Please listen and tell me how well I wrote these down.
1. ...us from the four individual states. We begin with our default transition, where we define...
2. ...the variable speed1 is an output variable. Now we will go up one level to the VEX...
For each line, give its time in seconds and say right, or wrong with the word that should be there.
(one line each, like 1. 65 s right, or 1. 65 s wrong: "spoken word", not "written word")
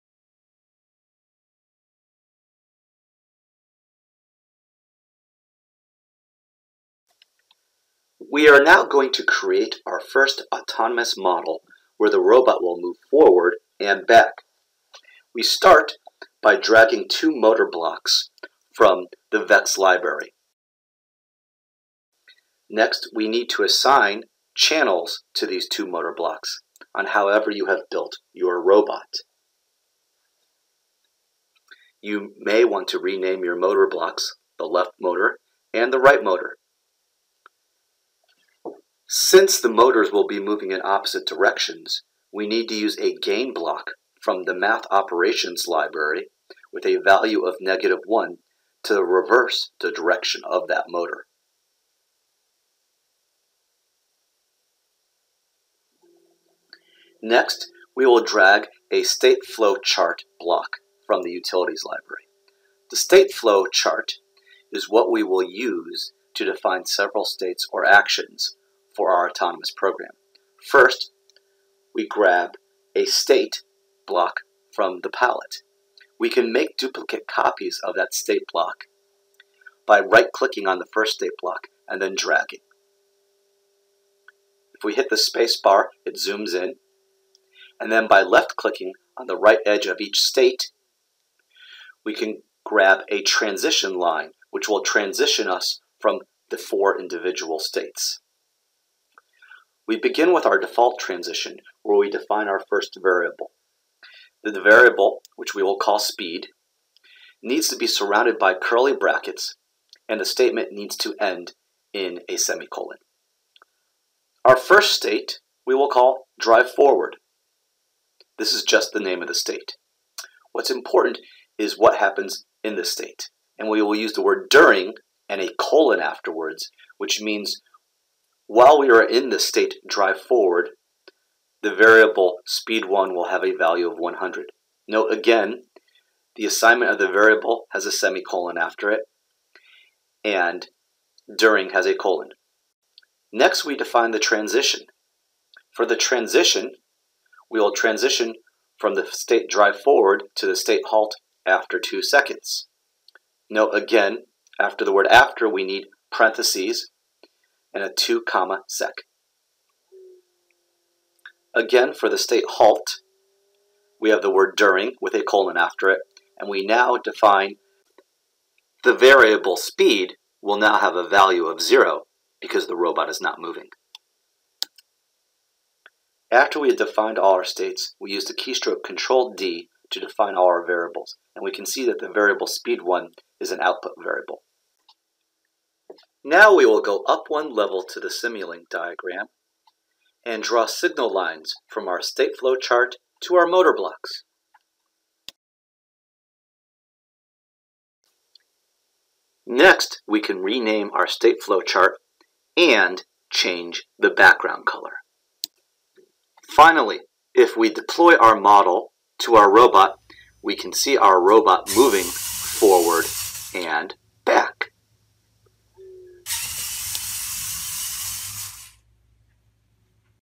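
1. 95 s right
2. 181 s wrong: "Simulink", not "VEX".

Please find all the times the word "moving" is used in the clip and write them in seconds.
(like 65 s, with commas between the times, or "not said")
40 s, 173 s, 211 s.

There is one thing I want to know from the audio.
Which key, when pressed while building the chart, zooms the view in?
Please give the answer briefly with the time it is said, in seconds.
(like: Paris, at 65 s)
Space bar, at 85 s.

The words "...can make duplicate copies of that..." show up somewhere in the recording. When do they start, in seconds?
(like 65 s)
76 s.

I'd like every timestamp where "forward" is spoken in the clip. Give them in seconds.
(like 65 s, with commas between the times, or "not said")
13 s, 116 s, 130 s, 149 s, 212 s.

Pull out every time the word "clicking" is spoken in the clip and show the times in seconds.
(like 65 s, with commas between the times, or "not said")
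79 s, 88 s.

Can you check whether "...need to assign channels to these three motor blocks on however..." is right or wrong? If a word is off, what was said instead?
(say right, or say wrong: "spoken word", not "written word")
wrong: "two", not "three".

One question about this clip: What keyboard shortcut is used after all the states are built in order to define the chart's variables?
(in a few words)
Control D.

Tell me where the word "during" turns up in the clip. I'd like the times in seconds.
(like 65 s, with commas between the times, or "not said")
124 s, 141 s, 164 s.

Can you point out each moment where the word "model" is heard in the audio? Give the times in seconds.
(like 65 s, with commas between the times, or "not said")
11 s, 208 s.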